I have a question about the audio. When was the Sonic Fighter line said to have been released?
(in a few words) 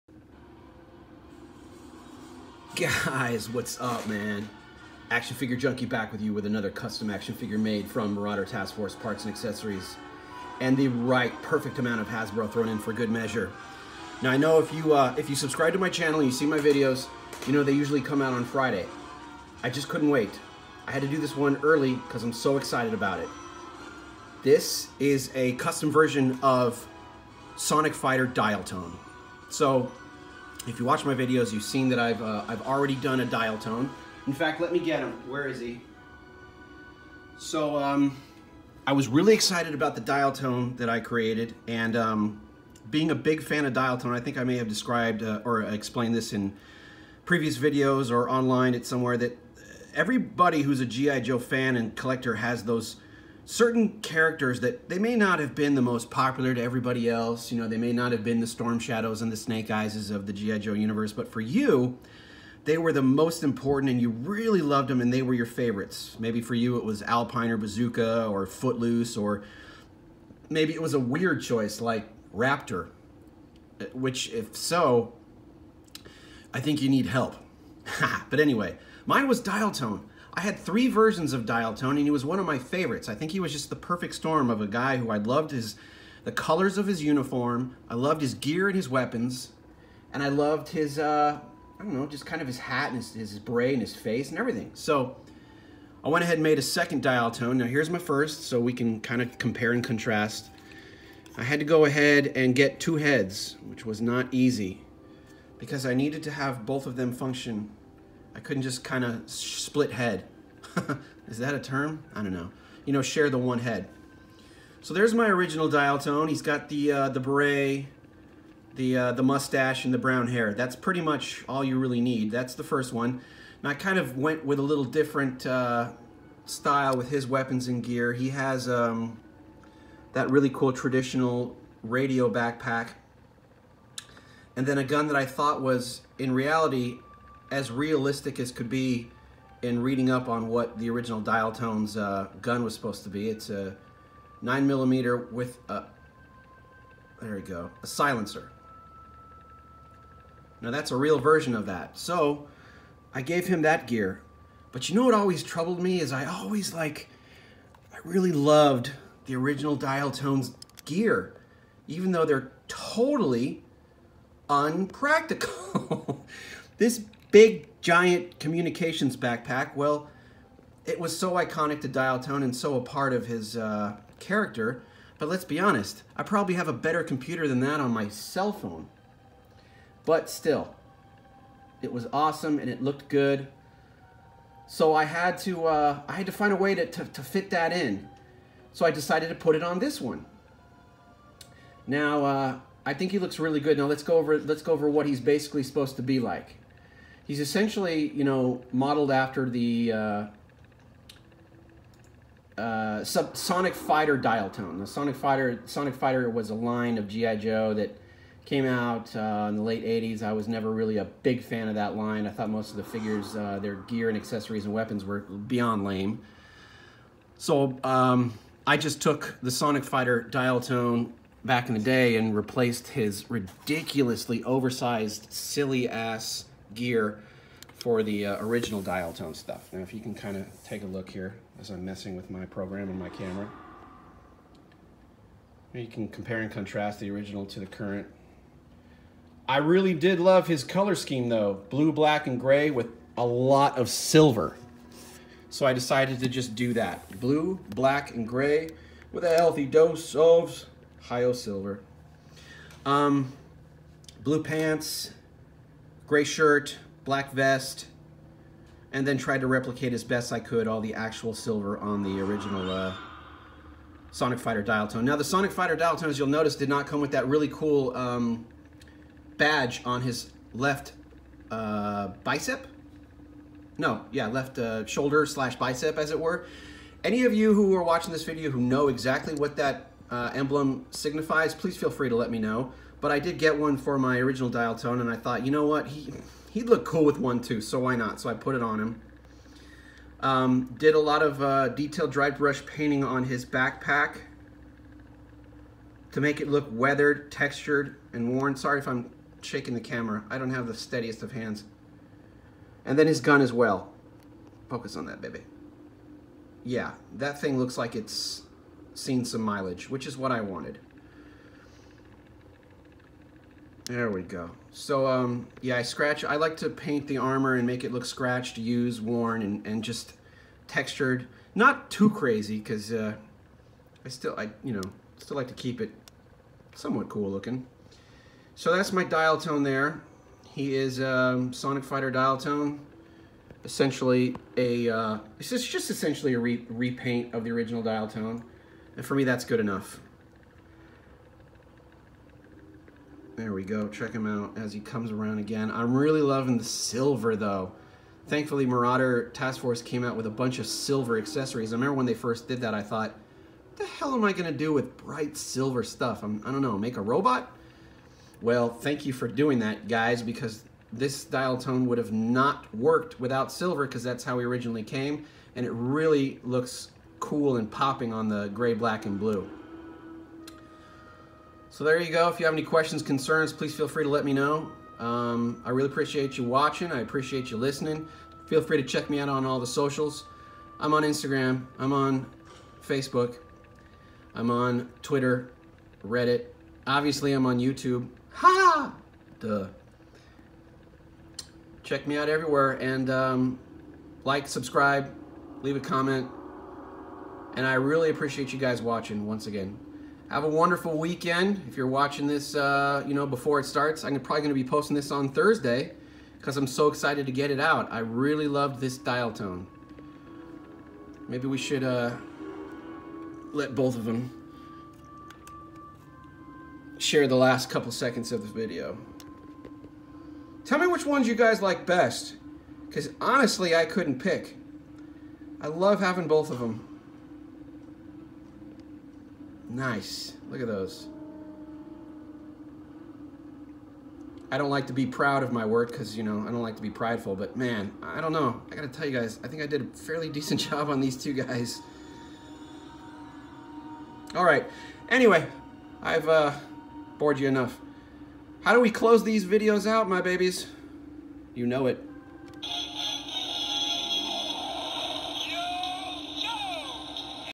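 late 80s.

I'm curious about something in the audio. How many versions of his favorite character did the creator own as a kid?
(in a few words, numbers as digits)
3.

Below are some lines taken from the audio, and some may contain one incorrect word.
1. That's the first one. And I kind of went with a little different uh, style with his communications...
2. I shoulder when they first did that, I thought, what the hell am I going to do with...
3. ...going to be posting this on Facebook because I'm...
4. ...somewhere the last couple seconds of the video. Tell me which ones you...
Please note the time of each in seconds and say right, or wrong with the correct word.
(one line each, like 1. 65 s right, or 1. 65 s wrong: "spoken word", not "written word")
1. 122 s wrong: "weapons", not "communications"
2. 351 s wrong: "remember", not "shoulder"
3. 404 s wrong: "Thursday", not "Facebook"
4. 416 s wrong: "share", not "somewhere".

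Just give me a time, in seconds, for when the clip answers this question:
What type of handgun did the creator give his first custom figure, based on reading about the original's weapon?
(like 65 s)
144 s.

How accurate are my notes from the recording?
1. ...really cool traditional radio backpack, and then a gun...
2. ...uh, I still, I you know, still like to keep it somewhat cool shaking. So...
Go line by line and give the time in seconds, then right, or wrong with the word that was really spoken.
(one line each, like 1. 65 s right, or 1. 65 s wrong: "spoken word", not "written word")
1. 130 s right
2. 322 s wrong: "looking", not "shaking".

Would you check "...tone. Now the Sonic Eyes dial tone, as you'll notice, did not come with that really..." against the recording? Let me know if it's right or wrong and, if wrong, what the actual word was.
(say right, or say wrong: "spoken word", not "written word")
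wrong: "Fighter", not "Eyes".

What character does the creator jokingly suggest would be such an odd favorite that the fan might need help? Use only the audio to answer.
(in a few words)
Raptor.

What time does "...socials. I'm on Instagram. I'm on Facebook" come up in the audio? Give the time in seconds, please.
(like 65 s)
379 s.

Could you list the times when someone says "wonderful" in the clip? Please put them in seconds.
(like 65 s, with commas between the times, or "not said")
400 s.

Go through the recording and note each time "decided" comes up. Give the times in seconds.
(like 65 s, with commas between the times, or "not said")
188 s, 245 s.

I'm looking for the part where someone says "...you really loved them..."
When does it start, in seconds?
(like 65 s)
64 s.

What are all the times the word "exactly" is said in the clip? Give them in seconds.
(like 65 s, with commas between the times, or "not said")
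278 s.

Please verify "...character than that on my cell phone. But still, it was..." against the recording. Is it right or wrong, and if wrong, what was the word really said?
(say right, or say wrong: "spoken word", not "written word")
wrong: "computer", not "character".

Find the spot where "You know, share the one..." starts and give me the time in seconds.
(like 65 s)
112 s.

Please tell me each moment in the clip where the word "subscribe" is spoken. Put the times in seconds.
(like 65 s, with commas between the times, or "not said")
15 s, 394 s.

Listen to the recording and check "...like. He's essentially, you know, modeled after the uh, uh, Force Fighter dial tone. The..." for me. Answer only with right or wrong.
wrong.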